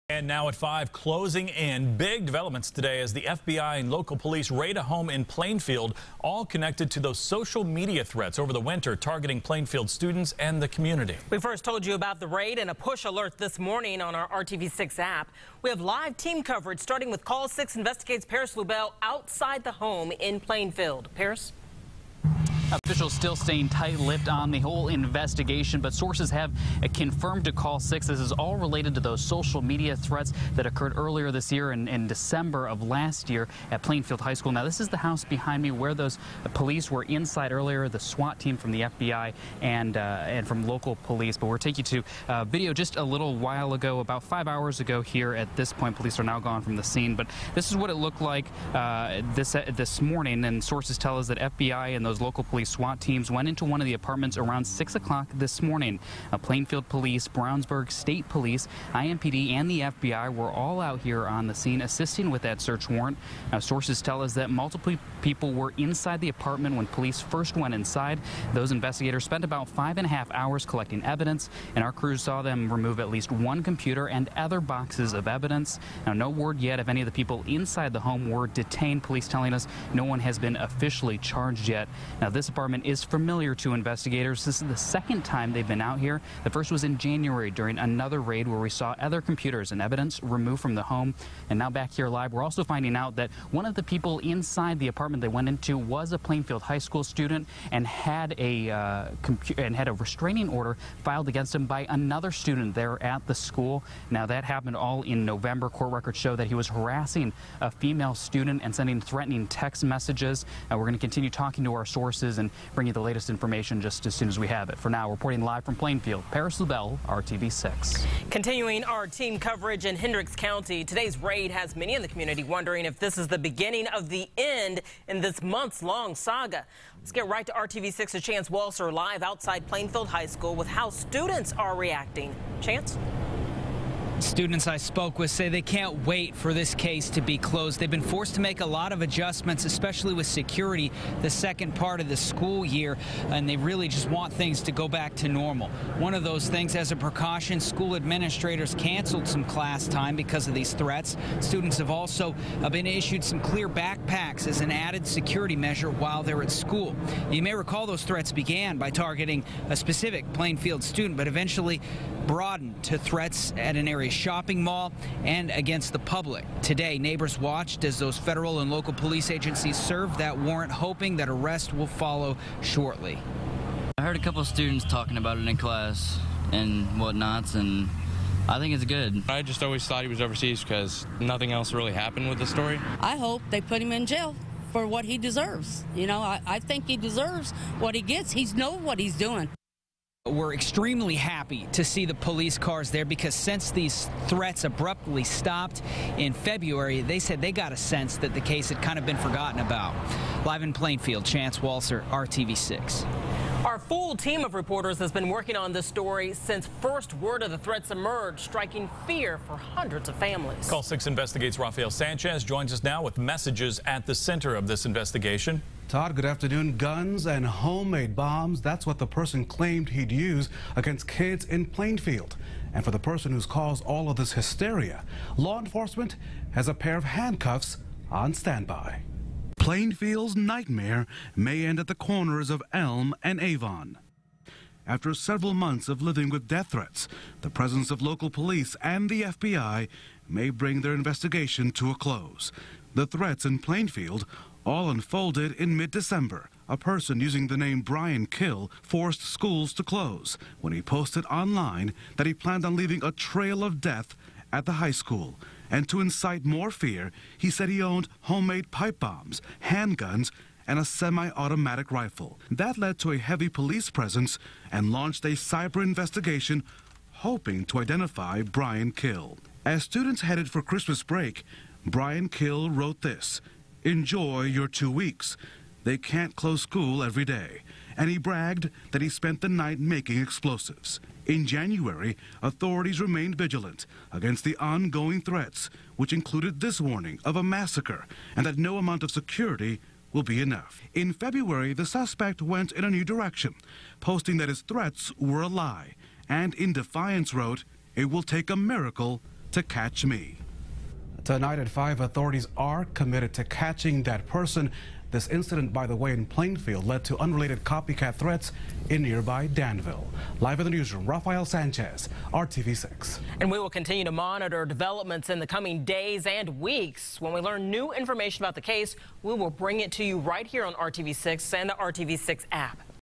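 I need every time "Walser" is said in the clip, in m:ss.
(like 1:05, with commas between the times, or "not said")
2:08, 3:21.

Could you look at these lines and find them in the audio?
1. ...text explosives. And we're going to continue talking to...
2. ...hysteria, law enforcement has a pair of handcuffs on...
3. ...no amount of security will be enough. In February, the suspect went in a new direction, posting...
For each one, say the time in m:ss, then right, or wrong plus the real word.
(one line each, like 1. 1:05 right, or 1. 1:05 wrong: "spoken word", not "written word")
1. 1:49 wrong: "messages", not "explosives"
2. 3:44 right
3. 4:48 right.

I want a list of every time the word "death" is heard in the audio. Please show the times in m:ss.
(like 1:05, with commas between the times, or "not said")
3:56, 4:13.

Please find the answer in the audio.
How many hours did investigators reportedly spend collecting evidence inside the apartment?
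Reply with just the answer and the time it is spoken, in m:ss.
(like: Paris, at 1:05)
5 and a half hours, at 1:09.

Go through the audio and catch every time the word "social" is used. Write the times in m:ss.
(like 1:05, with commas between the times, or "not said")
0:07, 0:29.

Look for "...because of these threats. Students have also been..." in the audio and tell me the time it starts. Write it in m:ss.
2:30.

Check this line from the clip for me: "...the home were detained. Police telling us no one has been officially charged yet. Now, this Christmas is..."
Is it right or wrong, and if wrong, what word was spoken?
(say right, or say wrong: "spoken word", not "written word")
wrong: "Department", not "Christmas".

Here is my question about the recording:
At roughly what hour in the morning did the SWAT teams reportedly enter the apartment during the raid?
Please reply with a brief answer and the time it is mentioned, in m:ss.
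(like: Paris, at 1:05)
6 o'clock, at 0:54.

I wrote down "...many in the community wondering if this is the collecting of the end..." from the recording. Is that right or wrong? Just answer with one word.
wrong.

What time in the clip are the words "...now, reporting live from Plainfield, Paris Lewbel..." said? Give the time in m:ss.
1:54.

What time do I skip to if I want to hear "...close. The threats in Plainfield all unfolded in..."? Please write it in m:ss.
4:01.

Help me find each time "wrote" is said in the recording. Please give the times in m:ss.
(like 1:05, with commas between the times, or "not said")
4:32, 4:57.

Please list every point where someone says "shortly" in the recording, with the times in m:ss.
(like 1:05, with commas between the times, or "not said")
2:52.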